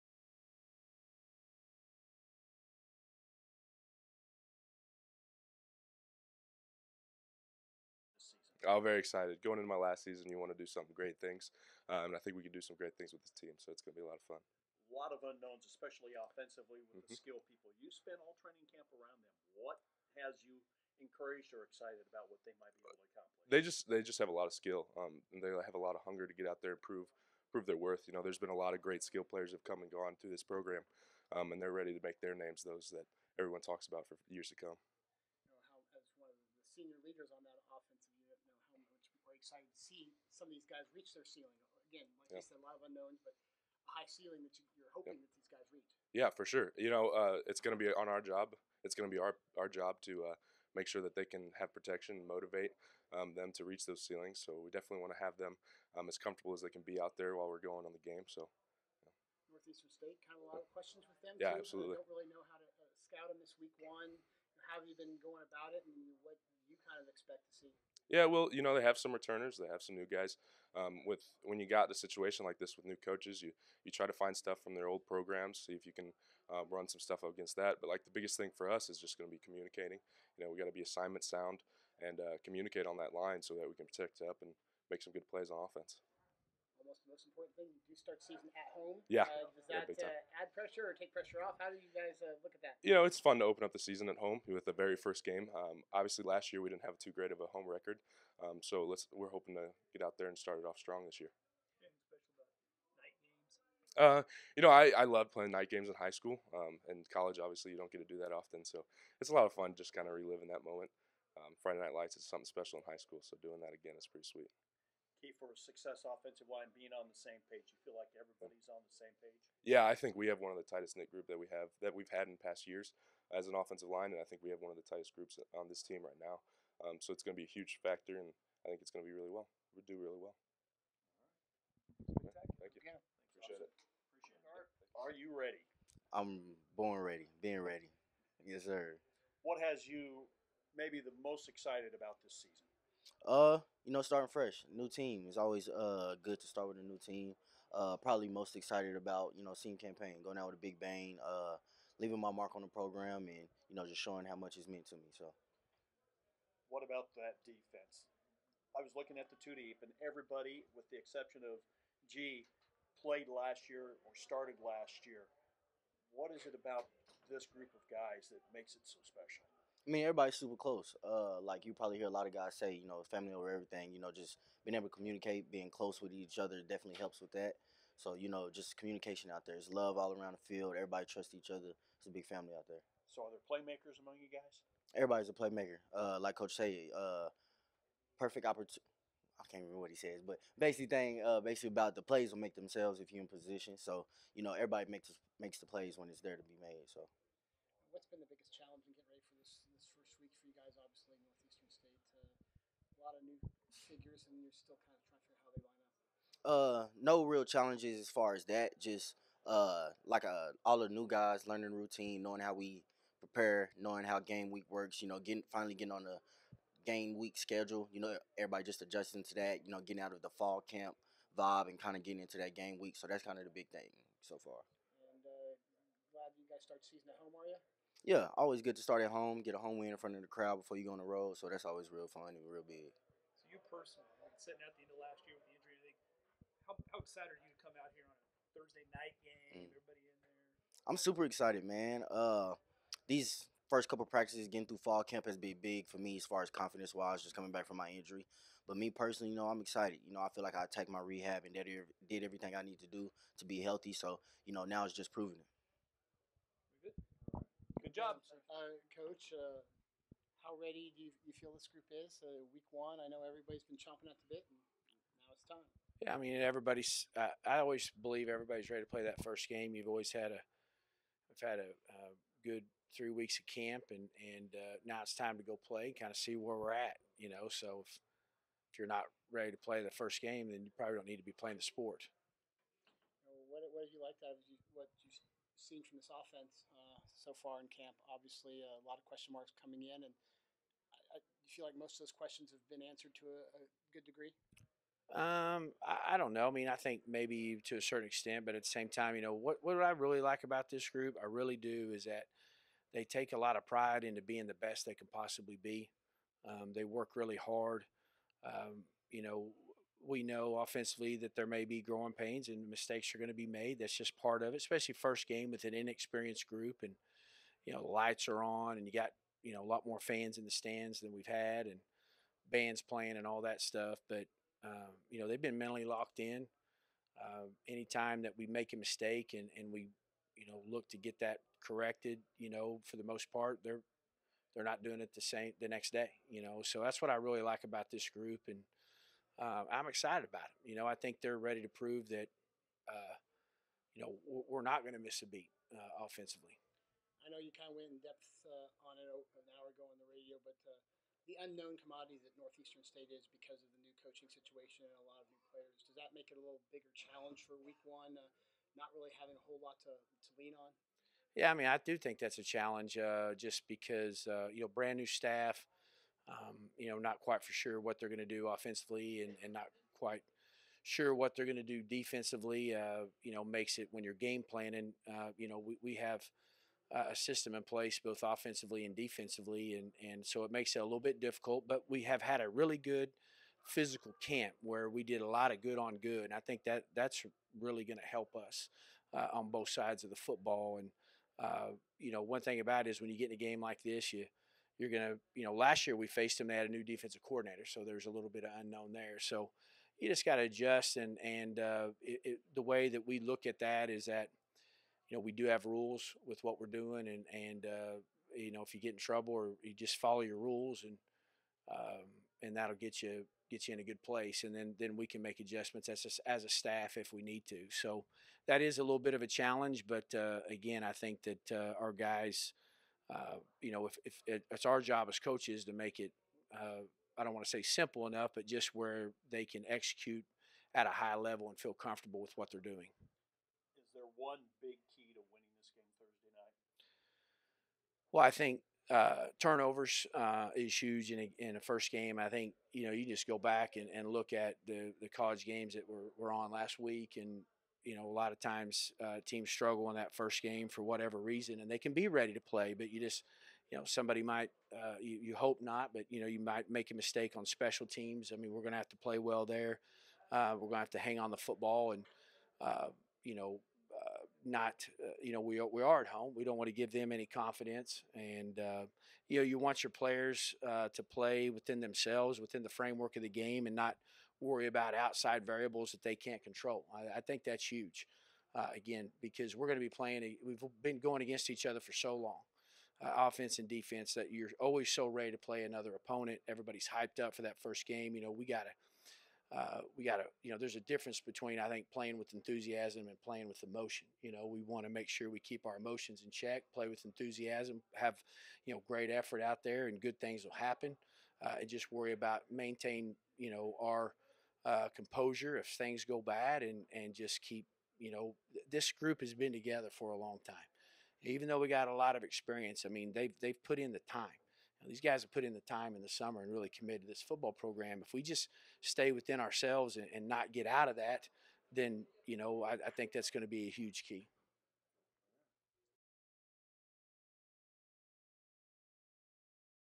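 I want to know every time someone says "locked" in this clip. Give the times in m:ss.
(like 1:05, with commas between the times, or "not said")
5:25.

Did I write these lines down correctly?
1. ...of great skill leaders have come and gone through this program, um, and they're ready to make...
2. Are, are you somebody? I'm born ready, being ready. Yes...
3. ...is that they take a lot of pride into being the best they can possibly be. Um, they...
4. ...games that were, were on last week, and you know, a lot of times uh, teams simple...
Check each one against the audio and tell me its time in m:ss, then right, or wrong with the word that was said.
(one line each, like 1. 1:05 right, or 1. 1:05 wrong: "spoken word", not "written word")
1. 0:28 wrong: "players", not "leaders"
2. 2:14 wrong: "ready", not "somebody"
3. 5:01 right
4. 7:25 wrong: "struggle", not "simple".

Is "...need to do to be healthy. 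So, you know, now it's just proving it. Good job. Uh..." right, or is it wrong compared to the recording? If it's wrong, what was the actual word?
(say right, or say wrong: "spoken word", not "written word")
right.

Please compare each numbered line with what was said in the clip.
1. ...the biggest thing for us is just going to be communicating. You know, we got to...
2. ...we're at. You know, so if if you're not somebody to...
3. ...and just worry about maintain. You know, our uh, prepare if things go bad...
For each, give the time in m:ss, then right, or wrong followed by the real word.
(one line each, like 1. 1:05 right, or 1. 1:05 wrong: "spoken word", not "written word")
1. 1:18 right
2. 4:36 wrong: "ready", not "somebody"
3. 8:21 wrong: "composure", not "prepare".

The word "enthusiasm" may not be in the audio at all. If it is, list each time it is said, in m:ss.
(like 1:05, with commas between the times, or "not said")
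8:12, 8:17.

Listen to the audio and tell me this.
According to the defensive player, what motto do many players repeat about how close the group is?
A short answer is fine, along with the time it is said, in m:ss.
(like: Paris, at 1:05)
Family over everything, at 2:53.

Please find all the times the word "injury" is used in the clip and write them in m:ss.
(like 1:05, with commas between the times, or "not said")
3:55, 4:07.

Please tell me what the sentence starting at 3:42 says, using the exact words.
So that's kind of the big thing so far.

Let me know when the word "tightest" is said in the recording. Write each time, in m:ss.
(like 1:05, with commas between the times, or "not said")
2:00, 2:04.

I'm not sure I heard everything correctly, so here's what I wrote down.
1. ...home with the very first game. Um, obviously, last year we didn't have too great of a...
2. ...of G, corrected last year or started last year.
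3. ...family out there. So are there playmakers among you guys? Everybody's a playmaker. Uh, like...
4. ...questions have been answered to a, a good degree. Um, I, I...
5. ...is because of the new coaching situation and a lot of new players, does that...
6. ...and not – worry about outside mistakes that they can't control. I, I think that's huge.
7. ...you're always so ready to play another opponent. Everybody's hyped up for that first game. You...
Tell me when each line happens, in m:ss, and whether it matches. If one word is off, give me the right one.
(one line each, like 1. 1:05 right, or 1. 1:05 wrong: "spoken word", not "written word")
1. 1:34 right
2. 2:41 wrong: "played", not "corrected"
3. 3:02 right
4. 4:52 right
5. 5:53 right
6. 7:53 wrong: "variables", not "mistakes"
7. 8:04 right.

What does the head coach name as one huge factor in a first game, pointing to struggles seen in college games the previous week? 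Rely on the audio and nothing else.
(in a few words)
Turnovers.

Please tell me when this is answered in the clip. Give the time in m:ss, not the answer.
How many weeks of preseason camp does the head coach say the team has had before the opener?
4:32.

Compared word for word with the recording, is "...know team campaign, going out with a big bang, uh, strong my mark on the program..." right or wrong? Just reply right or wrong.
wrong.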